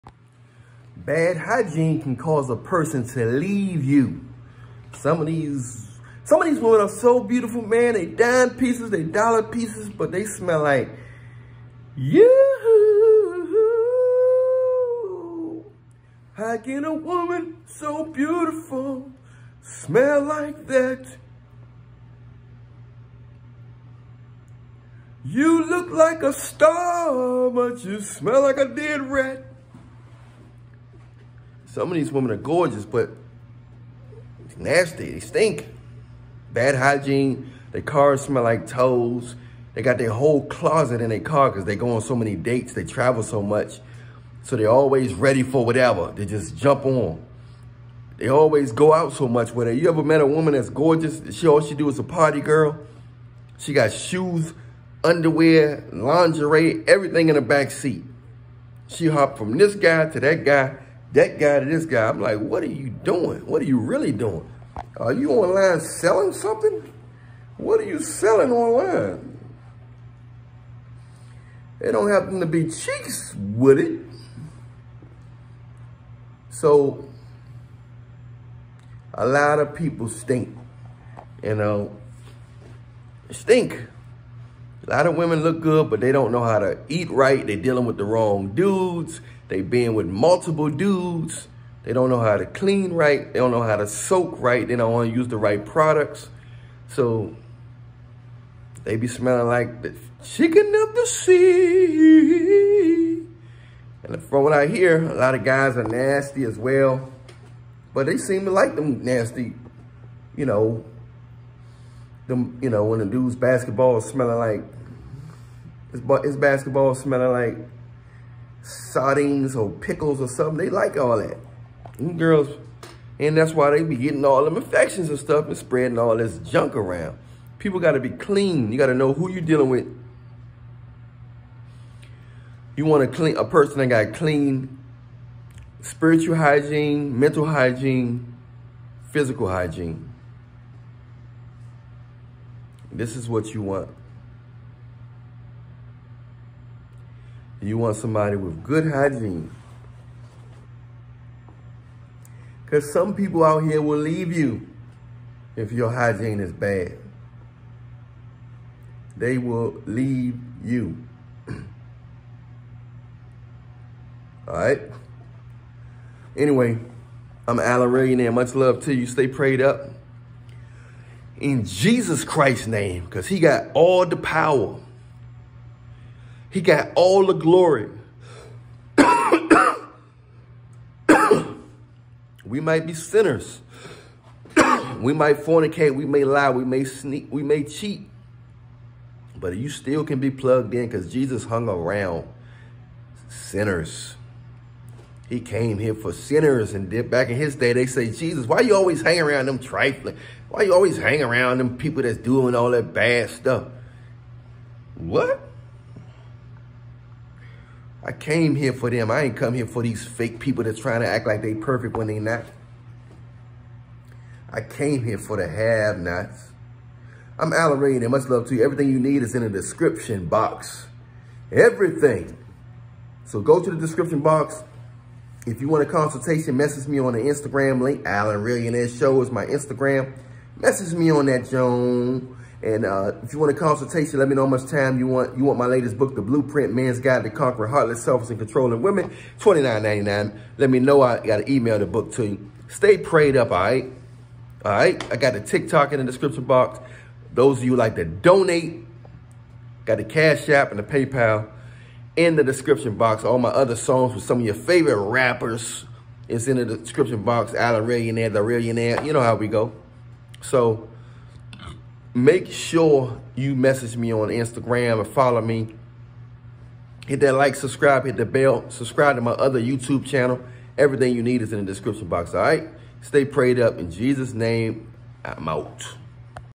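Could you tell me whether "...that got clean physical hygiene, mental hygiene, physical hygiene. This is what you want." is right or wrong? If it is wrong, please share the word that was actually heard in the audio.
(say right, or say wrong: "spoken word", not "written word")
wrong: "spiritual", not "physical".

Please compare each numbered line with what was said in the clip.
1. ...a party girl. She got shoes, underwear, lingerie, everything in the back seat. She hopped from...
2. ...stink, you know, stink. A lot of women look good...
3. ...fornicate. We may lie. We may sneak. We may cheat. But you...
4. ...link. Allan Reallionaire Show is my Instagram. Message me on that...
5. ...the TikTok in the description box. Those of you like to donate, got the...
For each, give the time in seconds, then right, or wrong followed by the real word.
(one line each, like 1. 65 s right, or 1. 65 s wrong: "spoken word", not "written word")
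1. 51 s right
2. 80 s right
3. 185 s right
4. 227 s right
5. 245 s right.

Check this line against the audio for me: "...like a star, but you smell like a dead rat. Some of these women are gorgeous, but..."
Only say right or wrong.
right.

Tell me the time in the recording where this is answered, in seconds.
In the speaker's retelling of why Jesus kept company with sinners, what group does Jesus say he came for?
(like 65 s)
215 s.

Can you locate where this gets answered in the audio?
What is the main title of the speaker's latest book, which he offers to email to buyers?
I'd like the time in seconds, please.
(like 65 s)
236 s.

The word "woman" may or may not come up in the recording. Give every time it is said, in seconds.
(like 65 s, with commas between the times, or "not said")
16 s, 50 s.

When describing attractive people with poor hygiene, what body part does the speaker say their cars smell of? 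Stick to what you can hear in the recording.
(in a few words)
Toes.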